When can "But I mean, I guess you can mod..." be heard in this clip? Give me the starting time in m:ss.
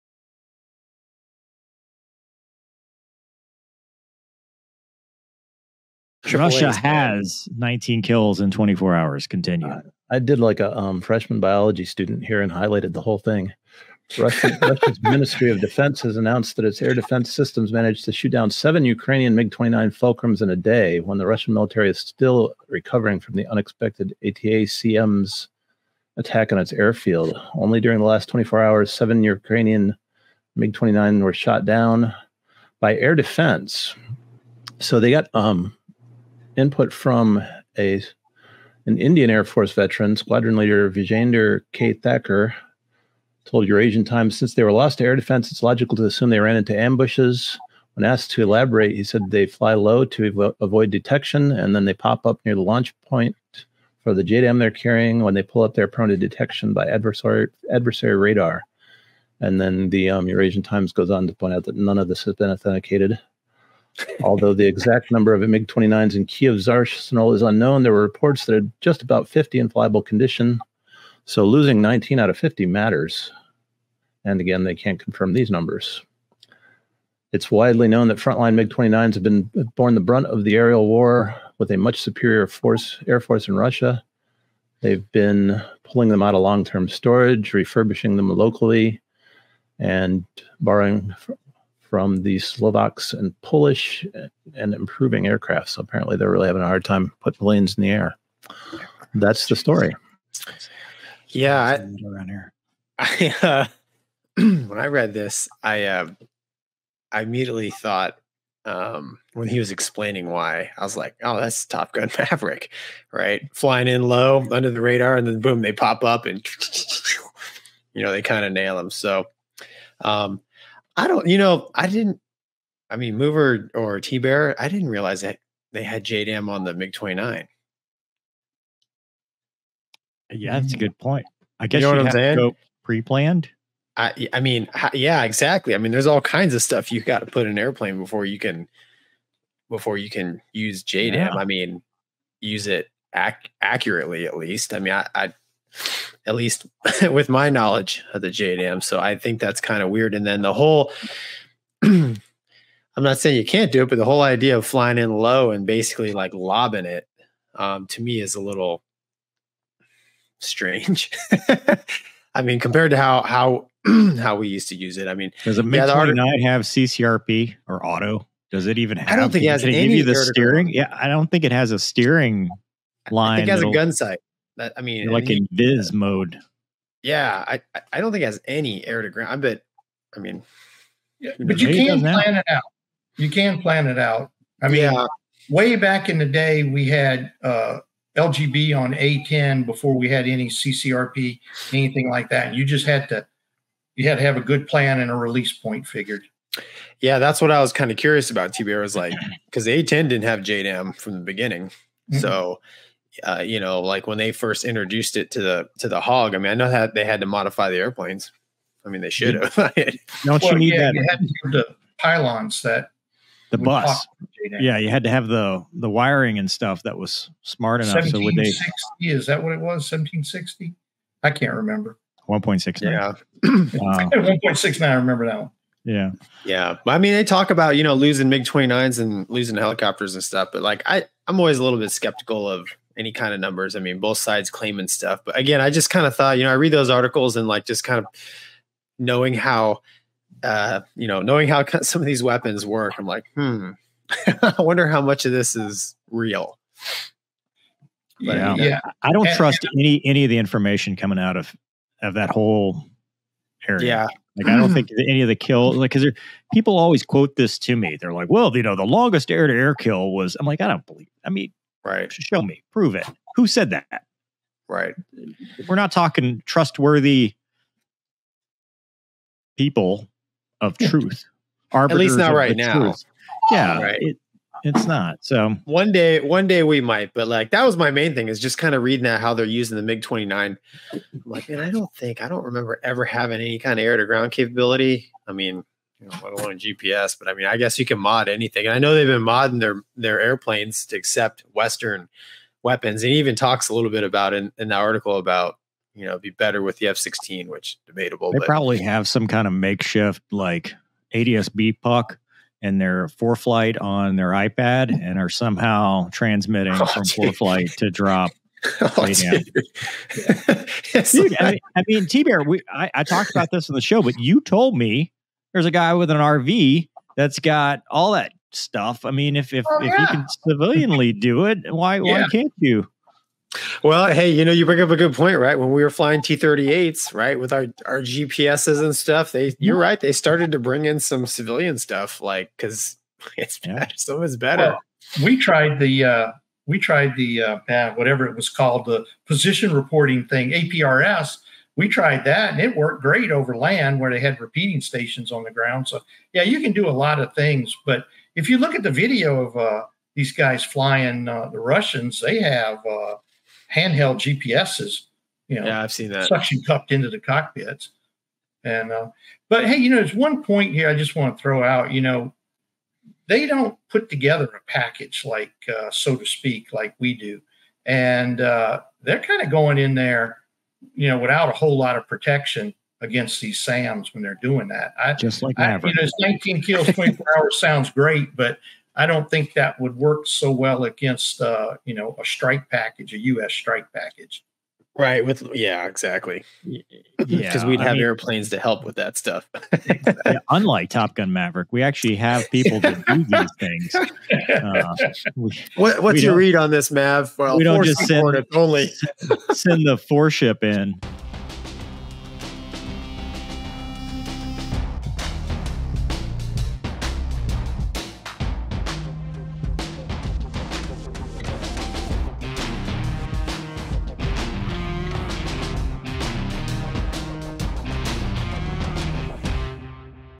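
4:47.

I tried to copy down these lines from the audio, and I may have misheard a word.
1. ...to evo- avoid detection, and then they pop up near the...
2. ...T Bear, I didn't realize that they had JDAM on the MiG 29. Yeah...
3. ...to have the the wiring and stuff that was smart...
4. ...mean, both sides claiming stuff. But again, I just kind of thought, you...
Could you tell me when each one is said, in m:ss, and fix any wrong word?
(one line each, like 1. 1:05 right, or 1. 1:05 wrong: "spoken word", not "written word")
1. 0:50 right
2. 2:04 right
3. 3:35 right
4. 3:53 right.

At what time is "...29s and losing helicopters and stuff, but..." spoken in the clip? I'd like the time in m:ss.
3:48.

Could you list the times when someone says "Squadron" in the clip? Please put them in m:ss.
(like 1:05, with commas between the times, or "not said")
0:40.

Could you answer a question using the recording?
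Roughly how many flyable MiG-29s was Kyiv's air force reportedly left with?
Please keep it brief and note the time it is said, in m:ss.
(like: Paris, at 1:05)
50, at 1:09.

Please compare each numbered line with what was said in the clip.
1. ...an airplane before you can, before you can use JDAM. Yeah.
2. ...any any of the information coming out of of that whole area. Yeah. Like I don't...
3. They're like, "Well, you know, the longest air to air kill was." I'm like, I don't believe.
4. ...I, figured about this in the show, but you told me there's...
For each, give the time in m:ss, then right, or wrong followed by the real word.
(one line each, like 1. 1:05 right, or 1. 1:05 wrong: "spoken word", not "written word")
1. 2:17 right
2. 4:09 right
3. 4:17 right
4. 5:12 wrong: "talked", not "figured".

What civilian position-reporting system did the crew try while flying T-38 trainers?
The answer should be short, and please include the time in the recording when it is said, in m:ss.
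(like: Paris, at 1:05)
APRS, at 5:40.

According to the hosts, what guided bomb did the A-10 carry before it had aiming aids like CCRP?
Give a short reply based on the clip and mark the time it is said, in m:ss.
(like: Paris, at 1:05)
LGB, at 3:08.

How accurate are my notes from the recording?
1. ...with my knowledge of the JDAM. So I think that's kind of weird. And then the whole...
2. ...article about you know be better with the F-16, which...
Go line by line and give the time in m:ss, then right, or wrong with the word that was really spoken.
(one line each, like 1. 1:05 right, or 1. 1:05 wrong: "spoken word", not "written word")
1. 2:27 wrong: "JDM", not "JDAM"
2. 4:54 right.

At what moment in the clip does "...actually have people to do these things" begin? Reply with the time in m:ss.
6:31.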